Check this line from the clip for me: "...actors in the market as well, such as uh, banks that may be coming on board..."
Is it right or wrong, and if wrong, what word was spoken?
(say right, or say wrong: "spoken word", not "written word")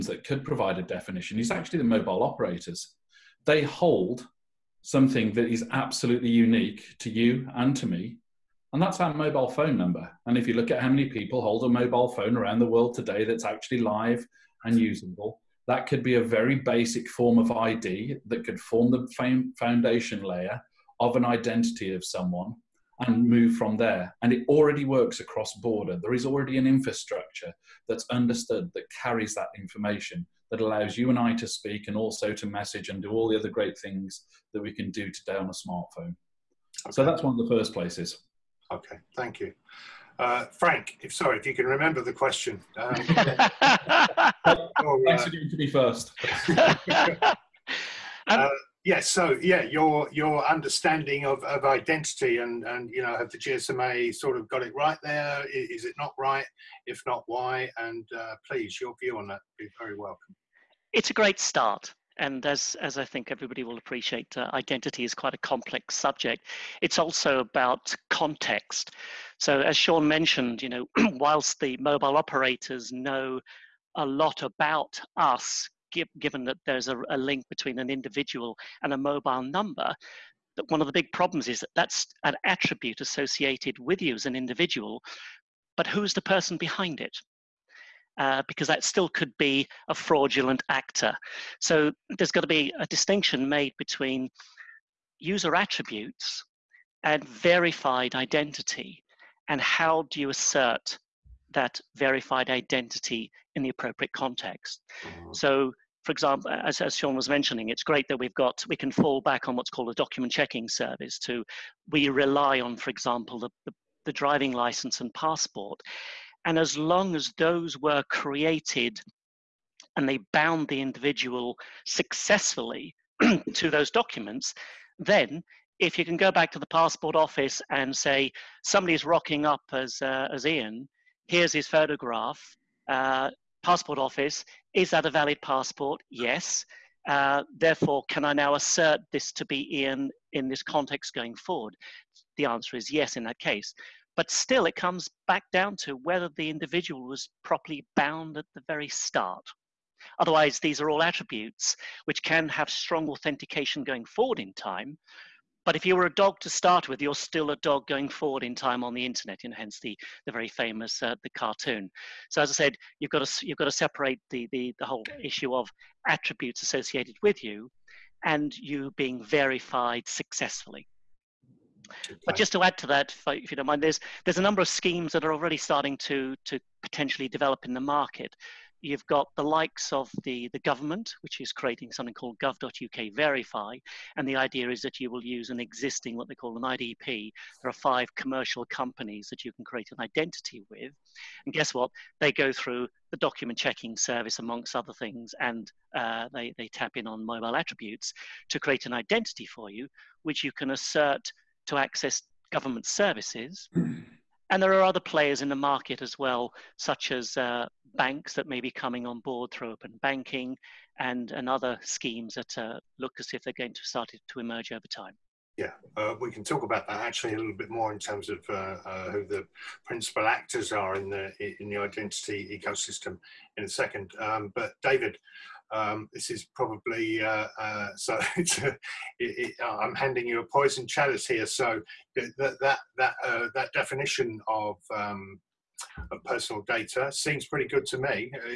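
wrong: "players", not "actors".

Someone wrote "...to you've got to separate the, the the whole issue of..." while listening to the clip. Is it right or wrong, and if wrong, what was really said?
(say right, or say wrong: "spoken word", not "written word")
right.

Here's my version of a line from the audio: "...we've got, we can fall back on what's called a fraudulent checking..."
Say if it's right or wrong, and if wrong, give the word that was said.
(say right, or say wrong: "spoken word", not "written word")
wrong: "document", not "fraudulent".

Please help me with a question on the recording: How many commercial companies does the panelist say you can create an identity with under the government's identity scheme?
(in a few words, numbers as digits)
5.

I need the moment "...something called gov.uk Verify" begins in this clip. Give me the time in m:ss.
3:01.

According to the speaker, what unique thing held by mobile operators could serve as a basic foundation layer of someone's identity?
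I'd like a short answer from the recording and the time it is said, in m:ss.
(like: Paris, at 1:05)
mobile phone number, at 0:09.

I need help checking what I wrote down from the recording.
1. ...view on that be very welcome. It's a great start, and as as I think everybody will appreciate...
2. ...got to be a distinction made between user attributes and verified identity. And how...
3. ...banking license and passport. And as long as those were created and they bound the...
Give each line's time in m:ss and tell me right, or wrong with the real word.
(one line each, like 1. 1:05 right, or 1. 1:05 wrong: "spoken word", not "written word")
1. 0:59 right
2. 1:32 right
3. 1:54 wrong: "driving", not "banking".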